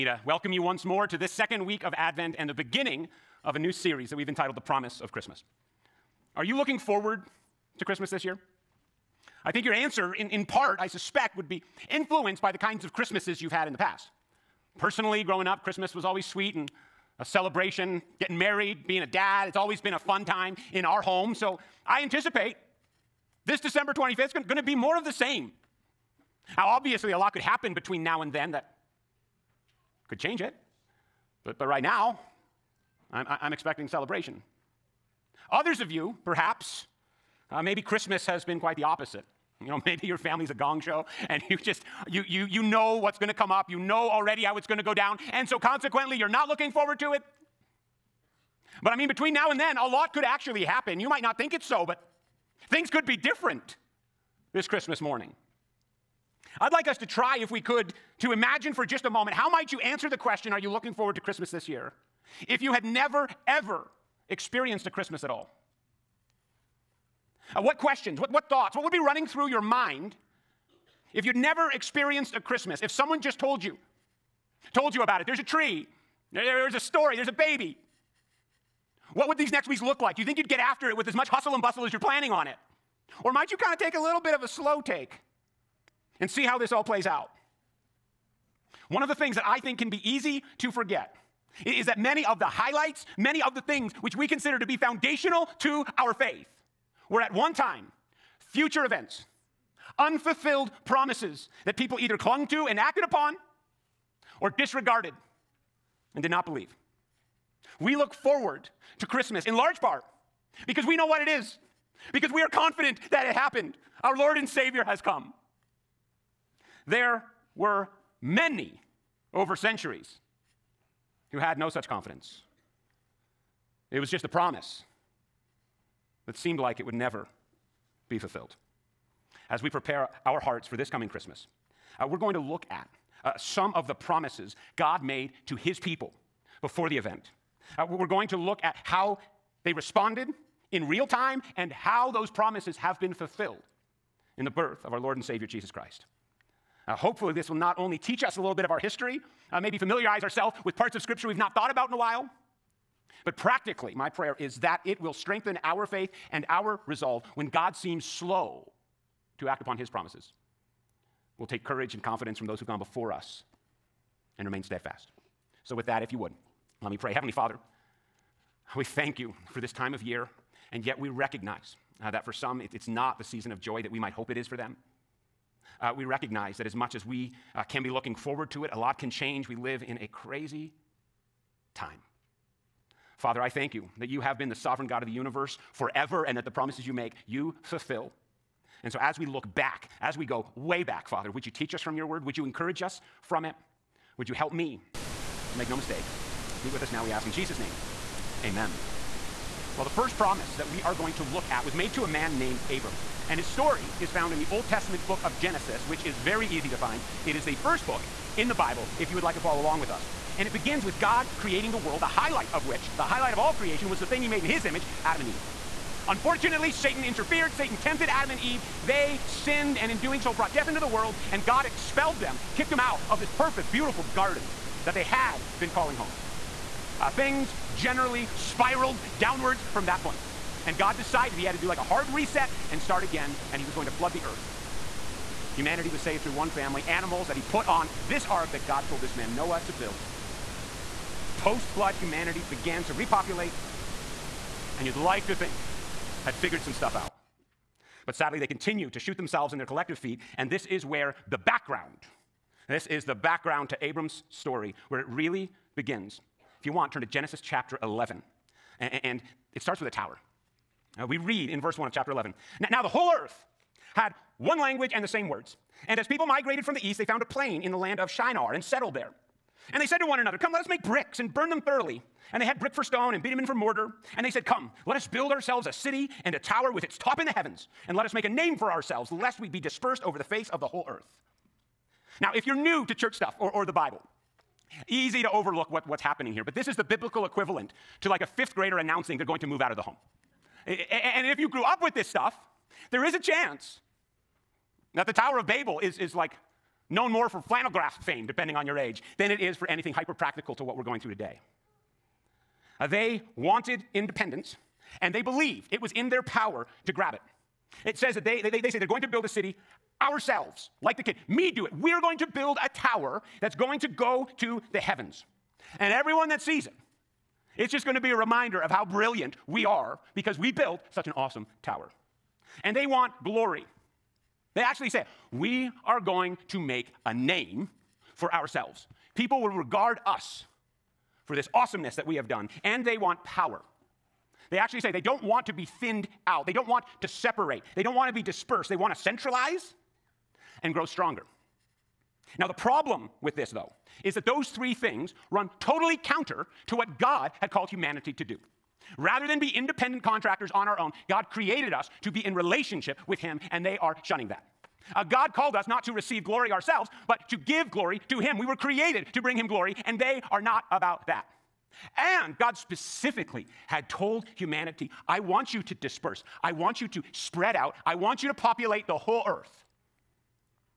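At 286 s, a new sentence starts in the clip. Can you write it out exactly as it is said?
But this is the biblical equivalent to like a fifth grader announcing they're going to move out of the home.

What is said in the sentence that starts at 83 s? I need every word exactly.
Or might you kind of take a little bit of a slow take?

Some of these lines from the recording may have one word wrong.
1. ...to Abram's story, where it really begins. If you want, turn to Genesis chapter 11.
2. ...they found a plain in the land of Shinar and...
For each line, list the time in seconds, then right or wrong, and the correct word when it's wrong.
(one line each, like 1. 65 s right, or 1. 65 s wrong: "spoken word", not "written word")
1. 253 s right
2. 266 s right.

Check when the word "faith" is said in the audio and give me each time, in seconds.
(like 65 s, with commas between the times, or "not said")
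96 s, 155 s.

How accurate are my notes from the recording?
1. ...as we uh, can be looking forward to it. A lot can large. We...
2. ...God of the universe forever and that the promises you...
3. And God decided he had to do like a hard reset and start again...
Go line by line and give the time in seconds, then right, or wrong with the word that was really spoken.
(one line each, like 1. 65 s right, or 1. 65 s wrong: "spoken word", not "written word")
1. 176 s wrong: "change", not "large"
2. 184 s right
3. 230 s right.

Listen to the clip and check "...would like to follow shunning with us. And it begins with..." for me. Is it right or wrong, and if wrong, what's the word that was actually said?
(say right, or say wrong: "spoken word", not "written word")
wrong: "along", not "shunning".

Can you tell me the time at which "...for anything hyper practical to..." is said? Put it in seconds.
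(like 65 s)
299 s.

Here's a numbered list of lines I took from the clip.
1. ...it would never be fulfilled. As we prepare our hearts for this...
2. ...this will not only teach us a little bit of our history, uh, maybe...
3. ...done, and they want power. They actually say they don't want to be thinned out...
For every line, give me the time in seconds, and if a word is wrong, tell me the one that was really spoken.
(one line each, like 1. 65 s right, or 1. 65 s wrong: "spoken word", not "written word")
1. 126 s right
2. 147 s right
3. 332 s right.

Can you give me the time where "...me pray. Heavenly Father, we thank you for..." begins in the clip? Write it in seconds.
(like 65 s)
166 s.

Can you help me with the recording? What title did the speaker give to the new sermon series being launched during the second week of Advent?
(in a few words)
The Promise of Christmas.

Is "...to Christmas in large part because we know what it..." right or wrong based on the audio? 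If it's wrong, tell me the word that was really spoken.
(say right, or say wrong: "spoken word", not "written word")
right.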